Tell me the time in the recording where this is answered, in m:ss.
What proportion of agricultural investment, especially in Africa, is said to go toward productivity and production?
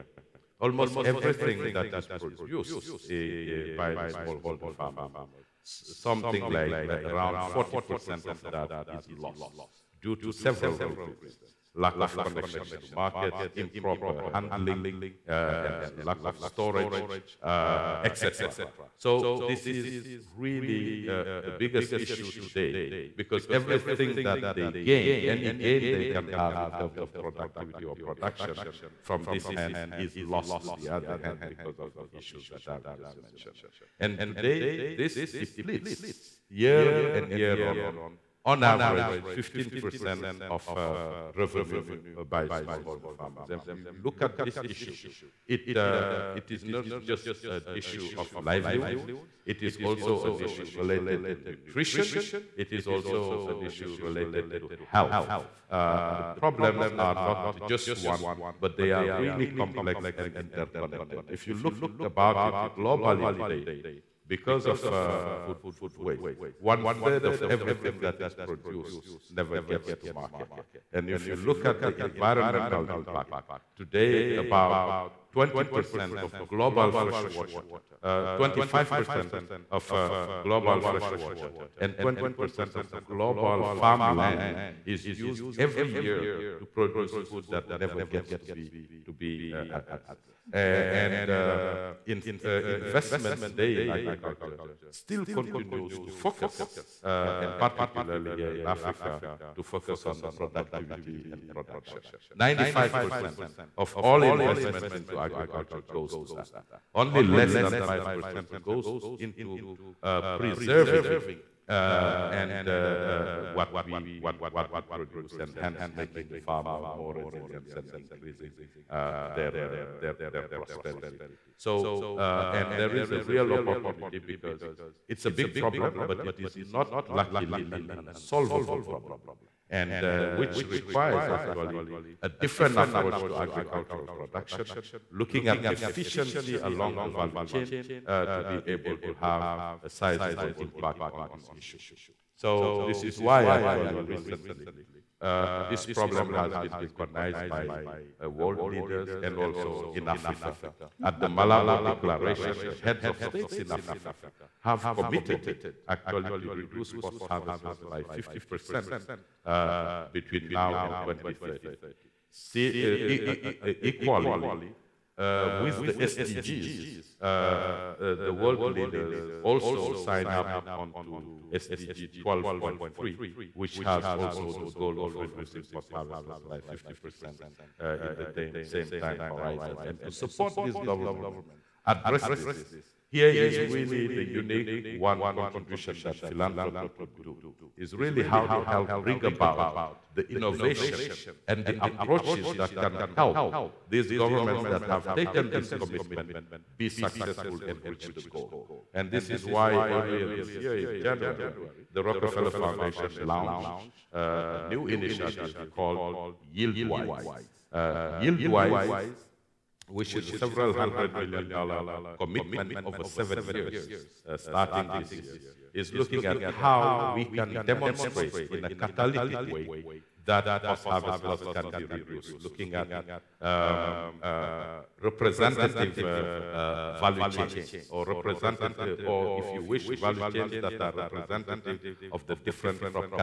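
1:42.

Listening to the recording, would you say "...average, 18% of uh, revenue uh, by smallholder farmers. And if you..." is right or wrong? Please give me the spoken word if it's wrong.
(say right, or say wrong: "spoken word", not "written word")
wrong: "15", not "18".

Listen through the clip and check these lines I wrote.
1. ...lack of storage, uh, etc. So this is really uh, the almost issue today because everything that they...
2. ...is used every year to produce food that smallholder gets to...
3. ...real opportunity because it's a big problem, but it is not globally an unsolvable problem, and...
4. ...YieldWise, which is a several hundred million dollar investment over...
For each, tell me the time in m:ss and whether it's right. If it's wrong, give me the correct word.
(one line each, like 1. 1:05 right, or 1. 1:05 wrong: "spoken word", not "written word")
1. 0:15 wrong: "biggest", not "almost"
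2. 1:24 wrong: "never", not "smallholder"
3. 2:03 wrong: "luckily", not "globally"
4. 3:28 wrong: "commitment", not "investment".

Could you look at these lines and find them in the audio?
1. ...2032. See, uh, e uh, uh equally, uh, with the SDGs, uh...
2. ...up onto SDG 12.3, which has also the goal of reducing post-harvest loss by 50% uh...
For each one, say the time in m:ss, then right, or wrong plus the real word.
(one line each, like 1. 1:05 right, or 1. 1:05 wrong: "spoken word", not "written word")
1. 2:41 wrong: "2030", not "2032"
2. 2:50 right.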